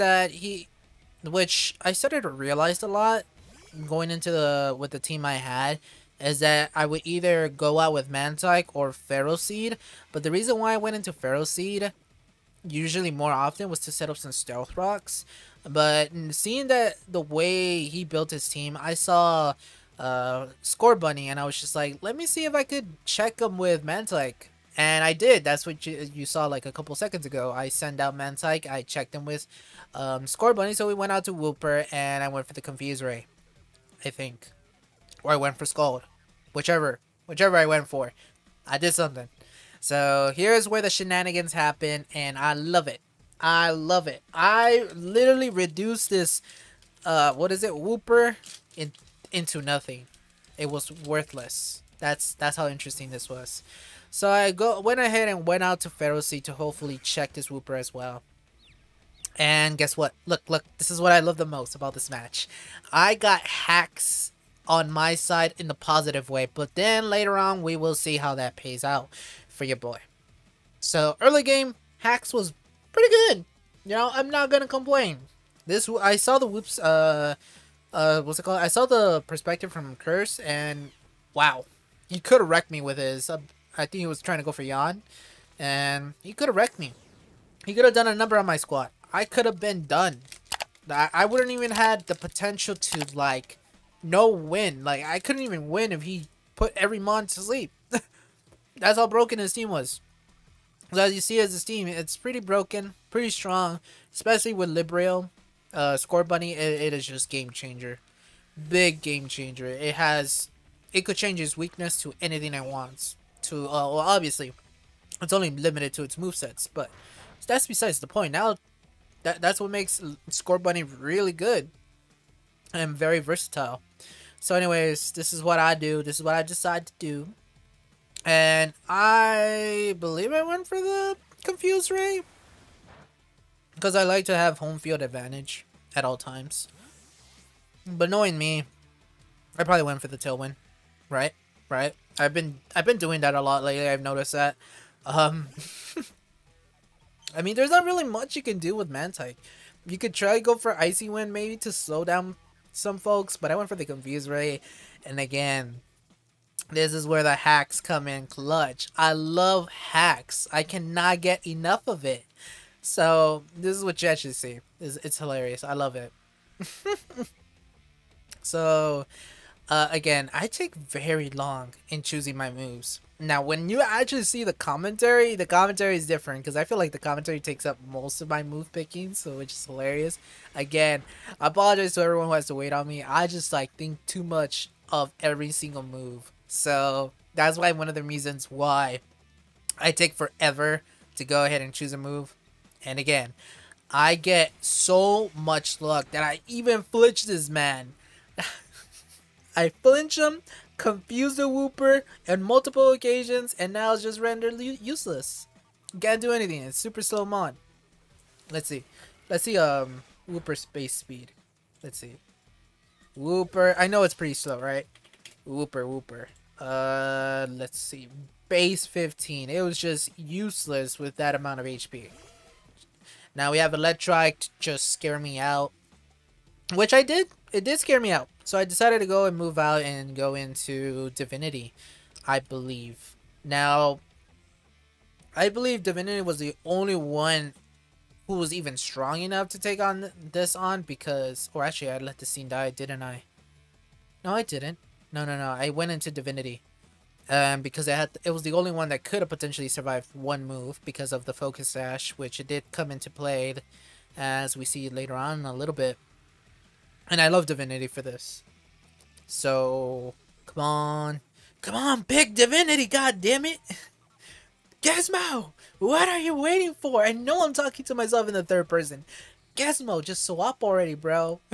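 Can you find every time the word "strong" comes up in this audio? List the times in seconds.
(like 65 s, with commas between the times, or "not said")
103 s, 238 s.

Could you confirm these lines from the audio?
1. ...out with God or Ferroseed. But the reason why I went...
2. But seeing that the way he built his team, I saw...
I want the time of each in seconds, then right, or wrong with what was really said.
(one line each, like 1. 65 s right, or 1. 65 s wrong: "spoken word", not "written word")
1. 7 s wrong: "Mantyke", not "God"
2. 15 s right.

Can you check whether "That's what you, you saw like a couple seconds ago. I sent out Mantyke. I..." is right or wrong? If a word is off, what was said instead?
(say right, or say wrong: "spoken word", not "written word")
right.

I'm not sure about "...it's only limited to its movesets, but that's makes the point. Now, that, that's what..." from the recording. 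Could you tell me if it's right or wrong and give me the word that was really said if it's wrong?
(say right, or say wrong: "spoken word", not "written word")
wrong: "besides", not "makes".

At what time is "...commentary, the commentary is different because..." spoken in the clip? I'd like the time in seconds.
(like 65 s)
174 s.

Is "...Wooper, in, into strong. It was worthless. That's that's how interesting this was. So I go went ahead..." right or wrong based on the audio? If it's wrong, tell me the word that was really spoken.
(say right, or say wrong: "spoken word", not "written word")
wrong: "nothing", not "strong".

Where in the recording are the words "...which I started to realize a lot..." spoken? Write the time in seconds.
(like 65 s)
1 s.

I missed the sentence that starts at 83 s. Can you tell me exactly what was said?
Uh, I think he was trying to go for Yan, and he could have wrecked me.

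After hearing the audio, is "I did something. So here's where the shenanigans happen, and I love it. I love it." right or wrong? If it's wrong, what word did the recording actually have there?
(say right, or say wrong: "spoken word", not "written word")
right.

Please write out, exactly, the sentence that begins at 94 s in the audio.
Like, I couldn't even win if he put every Mon to sleep.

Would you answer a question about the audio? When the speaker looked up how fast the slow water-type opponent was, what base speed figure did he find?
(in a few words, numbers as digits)
15.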